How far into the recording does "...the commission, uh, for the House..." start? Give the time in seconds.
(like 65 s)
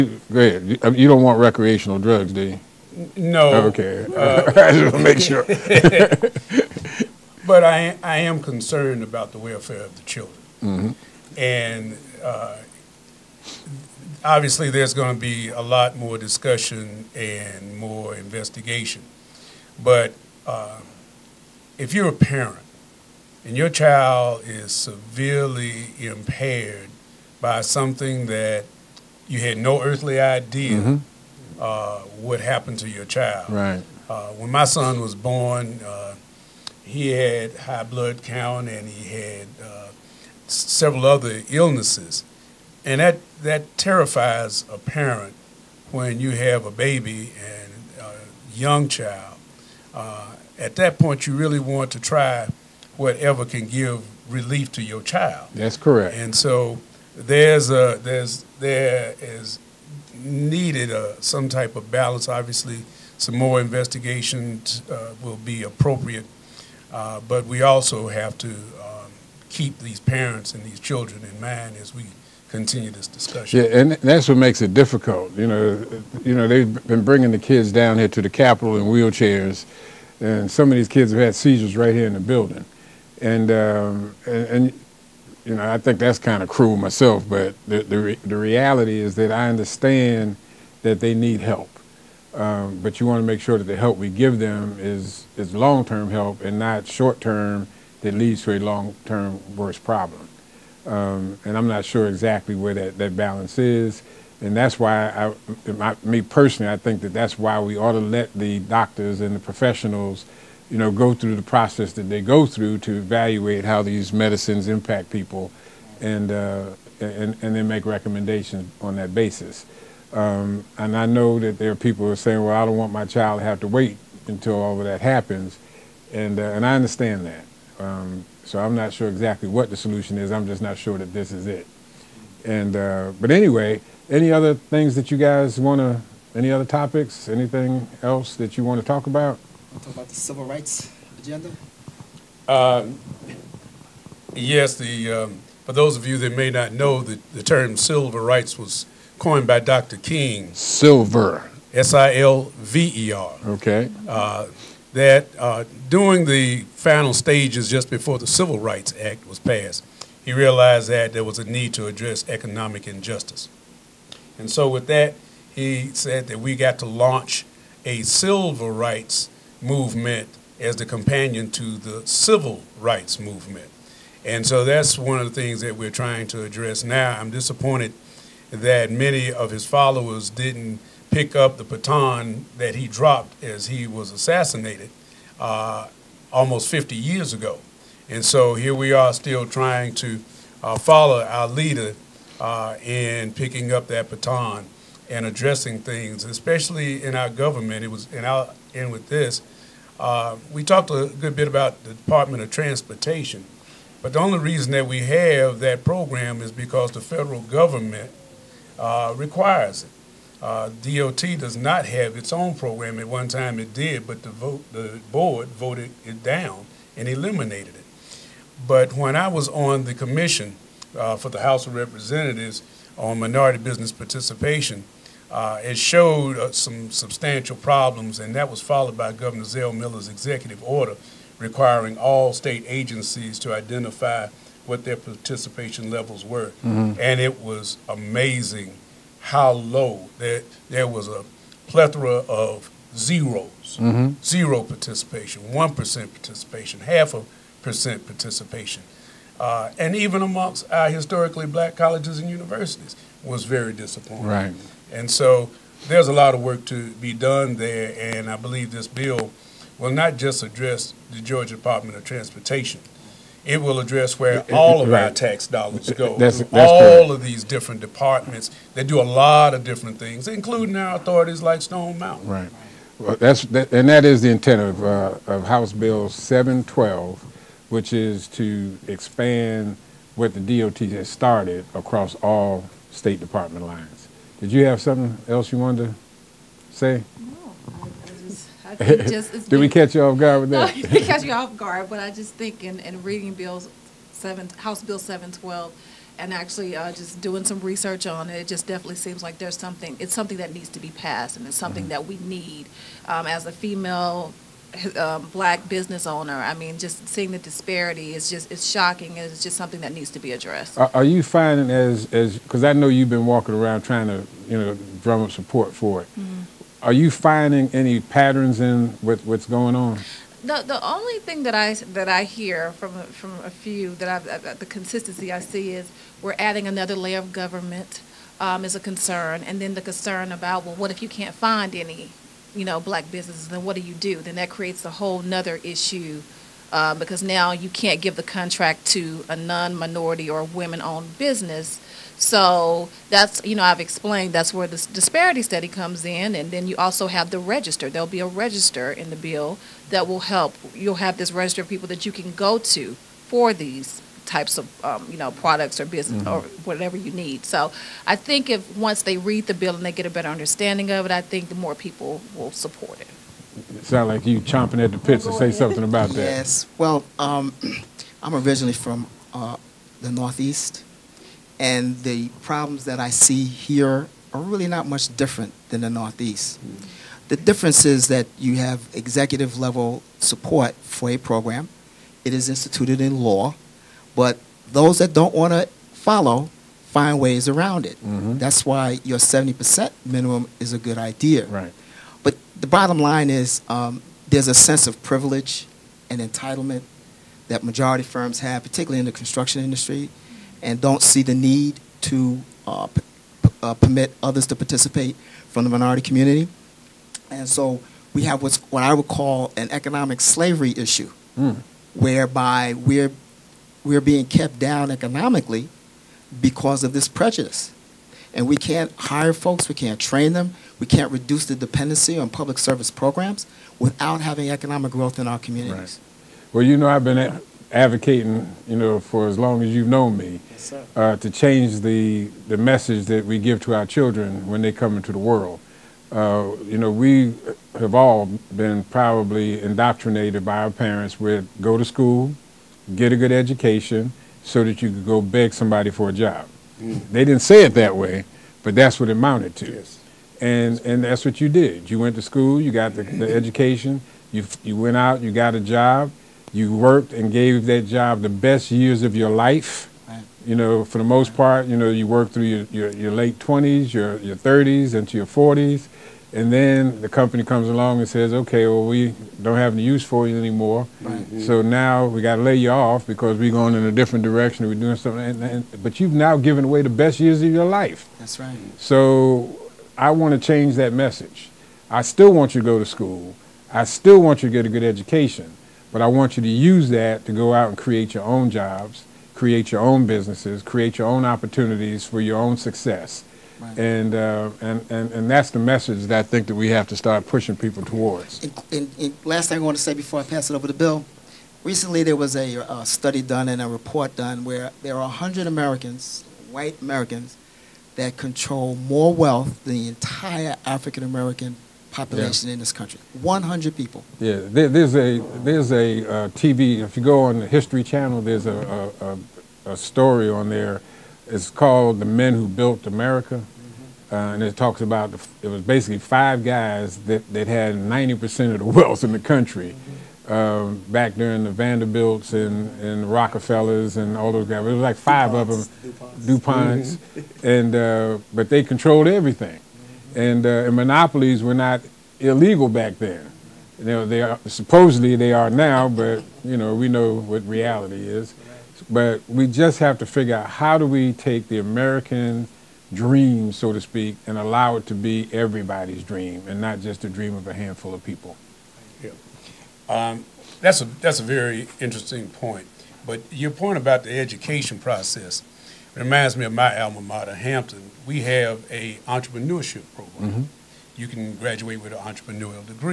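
219 s.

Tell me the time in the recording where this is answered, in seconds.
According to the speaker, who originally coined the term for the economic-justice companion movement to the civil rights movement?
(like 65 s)
149 s.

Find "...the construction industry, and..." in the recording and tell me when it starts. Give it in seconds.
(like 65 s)
399 s.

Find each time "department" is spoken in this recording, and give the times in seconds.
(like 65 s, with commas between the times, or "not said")
201 s, 261 s, 267 s, 283 s.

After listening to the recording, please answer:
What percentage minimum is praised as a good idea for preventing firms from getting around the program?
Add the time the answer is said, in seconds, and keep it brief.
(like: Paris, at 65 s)
70%, at 389 s.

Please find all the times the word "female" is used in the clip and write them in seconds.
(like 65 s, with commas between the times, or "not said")
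303 s.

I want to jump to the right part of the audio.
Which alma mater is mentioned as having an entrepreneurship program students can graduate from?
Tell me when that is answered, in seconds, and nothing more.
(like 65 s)
567 s.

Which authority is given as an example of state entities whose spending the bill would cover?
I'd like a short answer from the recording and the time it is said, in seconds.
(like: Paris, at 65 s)
Stone Mountain, at 271 s.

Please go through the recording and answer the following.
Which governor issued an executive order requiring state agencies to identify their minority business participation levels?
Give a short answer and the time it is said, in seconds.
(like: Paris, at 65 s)
Zell Miller, at 229 s.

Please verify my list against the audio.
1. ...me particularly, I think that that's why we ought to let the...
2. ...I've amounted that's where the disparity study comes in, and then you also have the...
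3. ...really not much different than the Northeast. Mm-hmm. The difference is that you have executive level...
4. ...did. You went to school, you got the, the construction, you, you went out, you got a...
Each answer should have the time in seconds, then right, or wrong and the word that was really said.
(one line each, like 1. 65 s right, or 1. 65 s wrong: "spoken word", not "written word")
1. 106 s wrong: "personally", not "particularly"
2. 343 s wrong: "explained", not "amounted"
3. 374 s right
4. 451 s wrong: "education", not "construction".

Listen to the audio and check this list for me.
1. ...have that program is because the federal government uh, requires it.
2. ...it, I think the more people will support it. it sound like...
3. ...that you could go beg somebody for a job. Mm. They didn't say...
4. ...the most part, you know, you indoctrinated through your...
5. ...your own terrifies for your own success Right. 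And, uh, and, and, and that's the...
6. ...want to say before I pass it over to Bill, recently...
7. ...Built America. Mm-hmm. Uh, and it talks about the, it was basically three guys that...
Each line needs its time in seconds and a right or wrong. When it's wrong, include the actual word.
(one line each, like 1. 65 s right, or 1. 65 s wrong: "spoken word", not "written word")
1. 205 s right
2. 361 s right
3. 444 s right
4. 460 s wrong: "worked", not "indoctrinated"
5. 491 s wrong: "opportunities", not "terrifies"
6. 499 s right
7. 522 s wrong: "five", not "three".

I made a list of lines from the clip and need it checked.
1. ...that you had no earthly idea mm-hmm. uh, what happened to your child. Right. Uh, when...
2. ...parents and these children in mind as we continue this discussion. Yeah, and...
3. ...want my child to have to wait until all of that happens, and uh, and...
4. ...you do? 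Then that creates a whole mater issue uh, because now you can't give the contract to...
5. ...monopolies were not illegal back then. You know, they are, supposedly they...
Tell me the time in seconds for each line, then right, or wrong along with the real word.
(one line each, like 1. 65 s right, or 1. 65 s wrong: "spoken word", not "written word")
1. 28 s right
2. 69 s right
3. 122 s right
4. 333 s wrong: "nother", not "mater"
5. 540 s right.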